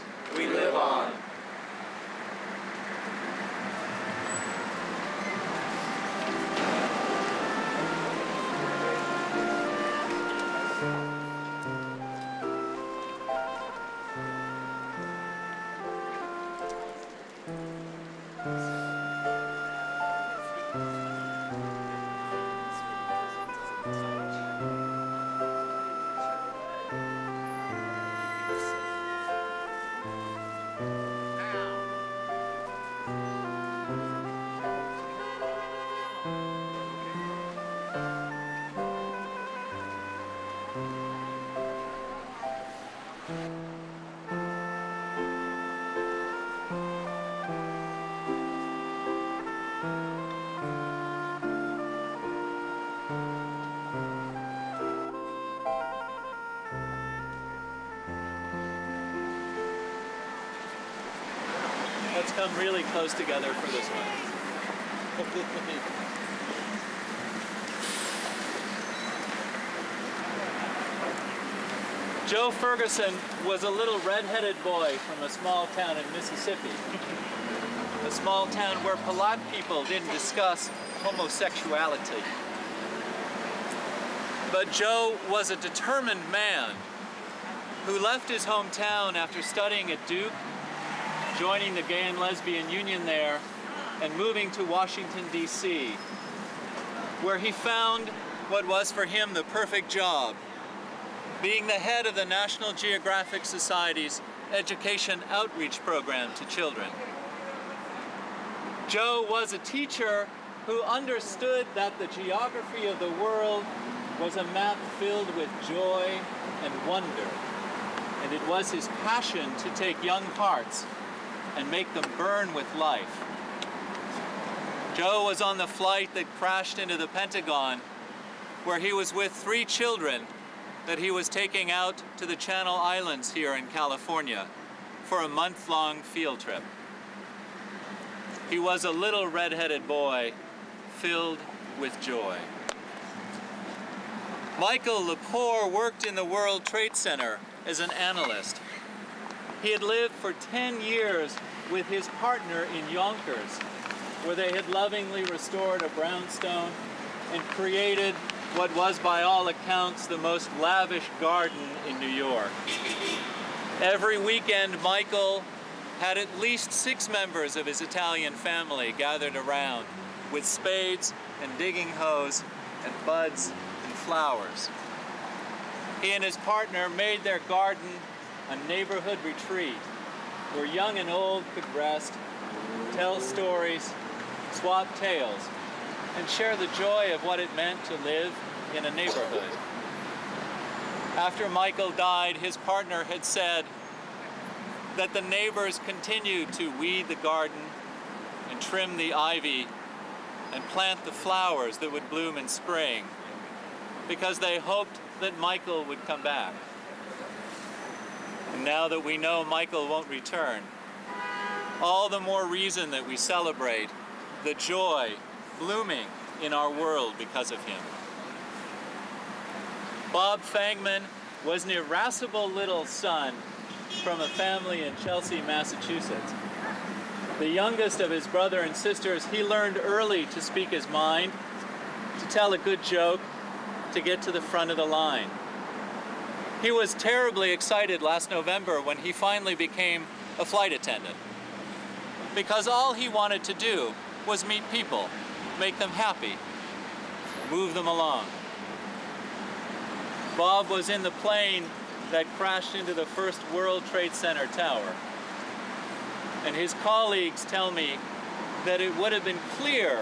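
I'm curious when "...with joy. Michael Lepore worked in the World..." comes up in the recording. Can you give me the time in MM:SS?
02:21.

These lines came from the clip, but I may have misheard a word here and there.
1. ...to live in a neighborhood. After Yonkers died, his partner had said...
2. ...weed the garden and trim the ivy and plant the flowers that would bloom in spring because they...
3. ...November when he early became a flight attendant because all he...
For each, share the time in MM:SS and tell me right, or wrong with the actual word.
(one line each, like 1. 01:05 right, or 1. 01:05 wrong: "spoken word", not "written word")
1. 03:07 wrong: "Michael", not "Yonkers"
2. 03:16 right
3. 03:58 wrong: "finally", not "early".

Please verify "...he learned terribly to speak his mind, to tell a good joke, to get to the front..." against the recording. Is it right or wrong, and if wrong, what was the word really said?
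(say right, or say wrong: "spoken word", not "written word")
wrong: "early", not "terribly".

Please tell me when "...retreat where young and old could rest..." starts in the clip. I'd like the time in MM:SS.
02:59.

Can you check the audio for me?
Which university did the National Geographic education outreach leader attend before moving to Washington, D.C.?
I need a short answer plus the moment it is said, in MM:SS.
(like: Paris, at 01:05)
Duke, at 01:30.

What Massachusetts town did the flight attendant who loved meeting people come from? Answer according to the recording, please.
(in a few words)
Chelsea.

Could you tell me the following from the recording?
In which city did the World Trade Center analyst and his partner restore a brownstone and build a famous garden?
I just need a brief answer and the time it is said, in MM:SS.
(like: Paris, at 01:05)
Yonkers, at 02:32.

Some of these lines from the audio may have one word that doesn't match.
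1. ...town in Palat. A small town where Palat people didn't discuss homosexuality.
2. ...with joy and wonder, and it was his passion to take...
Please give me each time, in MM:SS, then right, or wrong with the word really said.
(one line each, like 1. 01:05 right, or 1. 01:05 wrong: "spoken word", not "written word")
1. 01:15 wrong: "Mississippi", not "Palat"
2. 01:55 right.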